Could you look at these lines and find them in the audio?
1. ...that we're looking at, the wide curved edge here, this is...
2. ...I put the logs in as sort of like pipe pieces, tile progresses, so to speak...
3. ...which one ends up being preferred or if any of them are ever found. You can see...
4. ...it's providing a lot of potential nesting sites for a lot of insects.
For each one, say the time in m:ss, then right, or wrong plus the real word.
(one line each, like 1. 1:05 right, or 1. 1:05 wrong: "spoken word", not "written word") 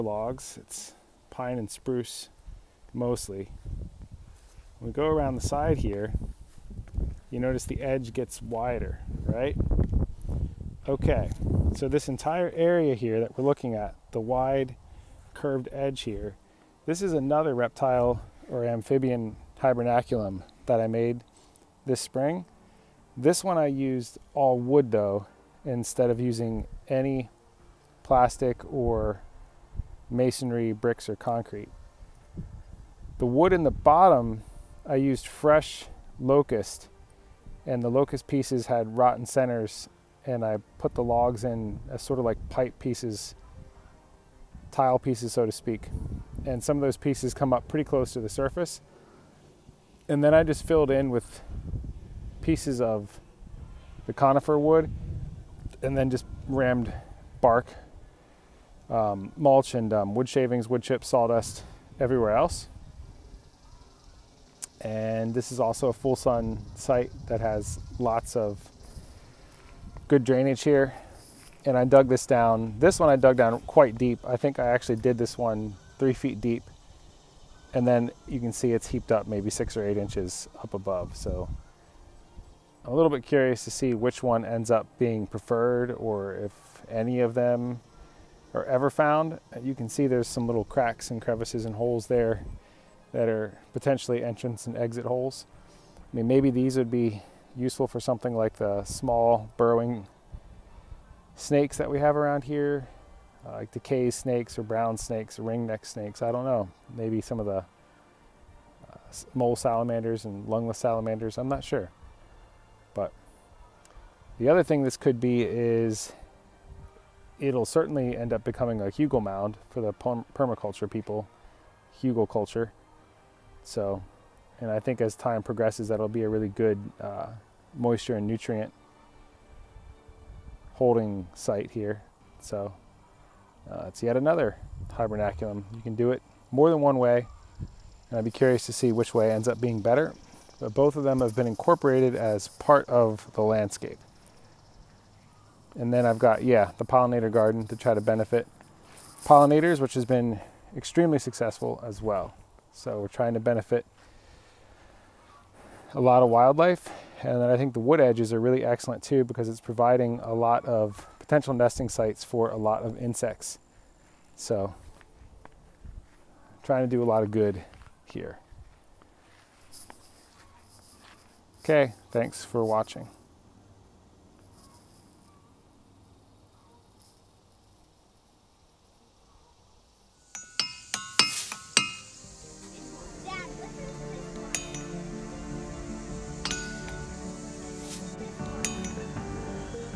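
1. 0:13 right
2. 0:40 wrong: "pieces", not "progresses"
3. 1:23 right
4. 2:39 right.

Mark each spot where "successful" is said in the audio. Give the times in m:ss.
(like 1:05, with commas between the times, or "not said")
2:31.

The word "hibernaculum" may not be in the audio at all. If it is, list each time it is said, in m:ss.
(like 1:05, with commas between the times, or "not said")
0:19, 2:14.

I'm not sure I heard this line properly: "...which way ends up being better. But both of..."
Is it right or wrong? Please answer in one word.
right.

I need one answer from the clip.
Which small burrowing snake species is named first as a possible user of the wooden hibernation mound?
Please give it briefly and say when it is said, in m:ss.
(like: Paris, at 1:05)
DeKay snakes, at 1:43.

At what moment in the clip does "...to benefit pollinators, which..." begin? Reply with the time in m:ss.
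2:27.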